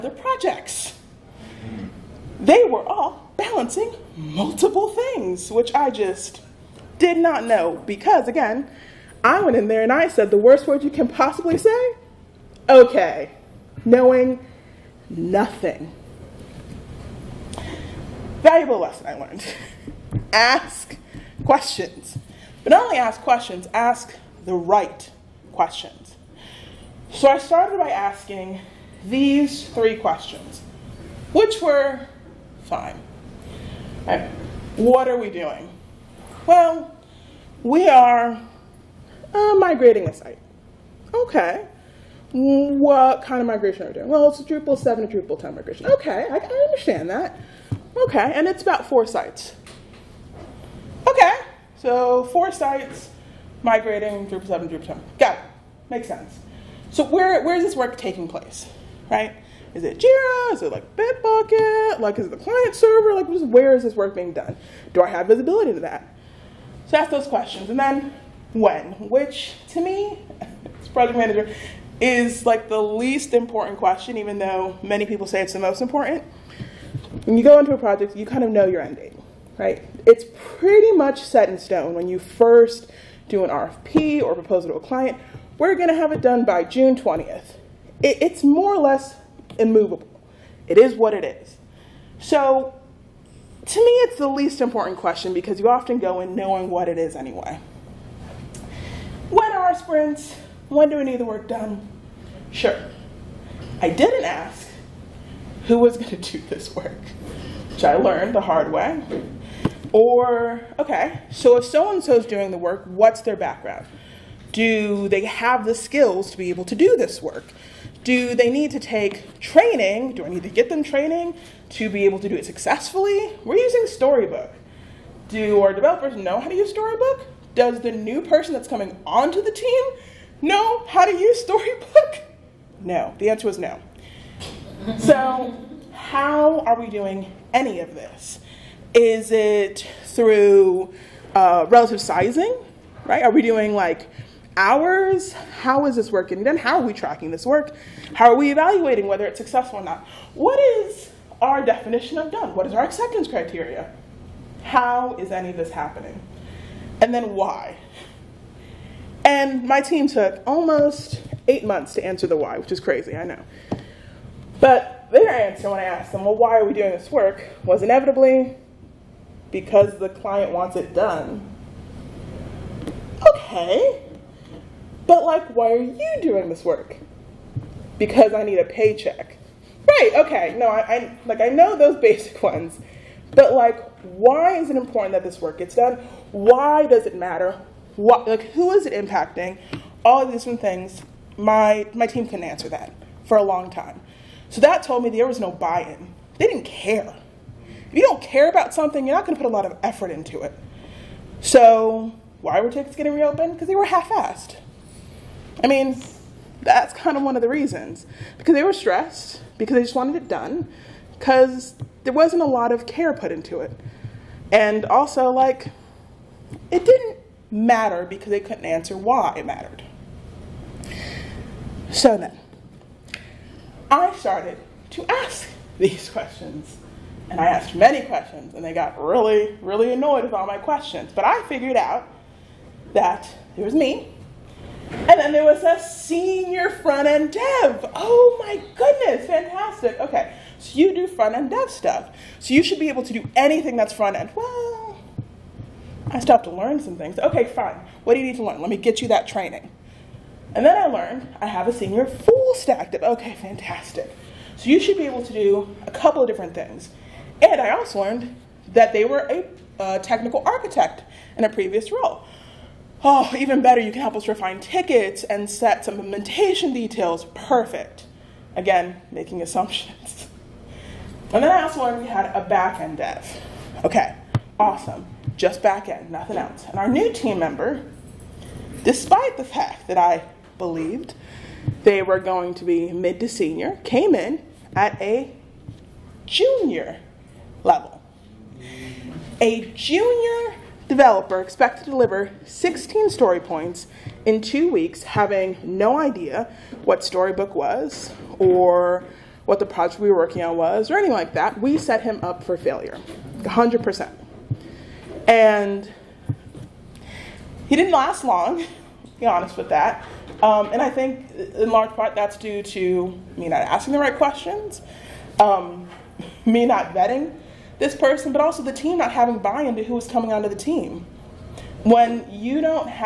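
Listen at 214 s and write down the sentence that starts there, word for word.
And also, like, it didn't matter because they couldn't answer why it mattered.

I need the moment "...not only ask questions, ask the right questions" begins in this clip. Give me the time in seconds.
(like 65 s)
22 s.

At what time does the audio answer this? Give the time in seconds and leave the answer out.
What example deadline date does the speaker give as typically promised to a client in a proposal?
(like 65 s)
86 s.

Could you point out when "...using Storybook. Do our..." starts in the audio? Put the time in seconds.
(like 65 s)
123 s.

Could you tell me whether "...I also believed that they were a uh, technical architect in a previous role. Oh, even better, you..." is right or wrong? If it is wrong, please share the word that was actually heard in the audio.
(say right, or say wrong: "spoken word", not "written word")
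wrong: "learned", not "believed".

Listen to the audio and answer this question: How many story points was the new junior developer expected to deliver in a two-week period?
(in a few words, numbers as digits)
16.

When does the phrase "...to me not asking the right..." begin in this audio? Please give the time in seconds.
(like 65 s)
312 s.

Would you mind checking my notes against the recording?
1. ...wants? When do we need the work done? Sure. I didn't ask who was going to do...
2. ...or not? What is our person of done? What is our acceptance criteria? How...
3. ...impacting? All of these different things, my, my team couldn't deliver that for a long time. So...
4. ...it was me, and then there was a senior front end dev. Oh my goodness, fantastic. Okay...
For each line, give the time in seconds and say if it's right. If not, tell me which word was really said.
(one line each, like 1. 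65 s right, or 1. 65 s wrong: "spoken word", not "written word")
1. 99 s wrong: "sprints", not "wants"
2. 149 s wrong: "definition", not "person"
3. 188 s wrong: "answer", not "deliver"
4. 233 s right.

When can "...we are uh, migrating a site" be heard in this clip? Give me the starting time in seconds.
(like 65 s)
37 s.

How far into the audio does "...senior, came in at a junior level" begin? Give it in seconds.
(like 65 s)
283 s.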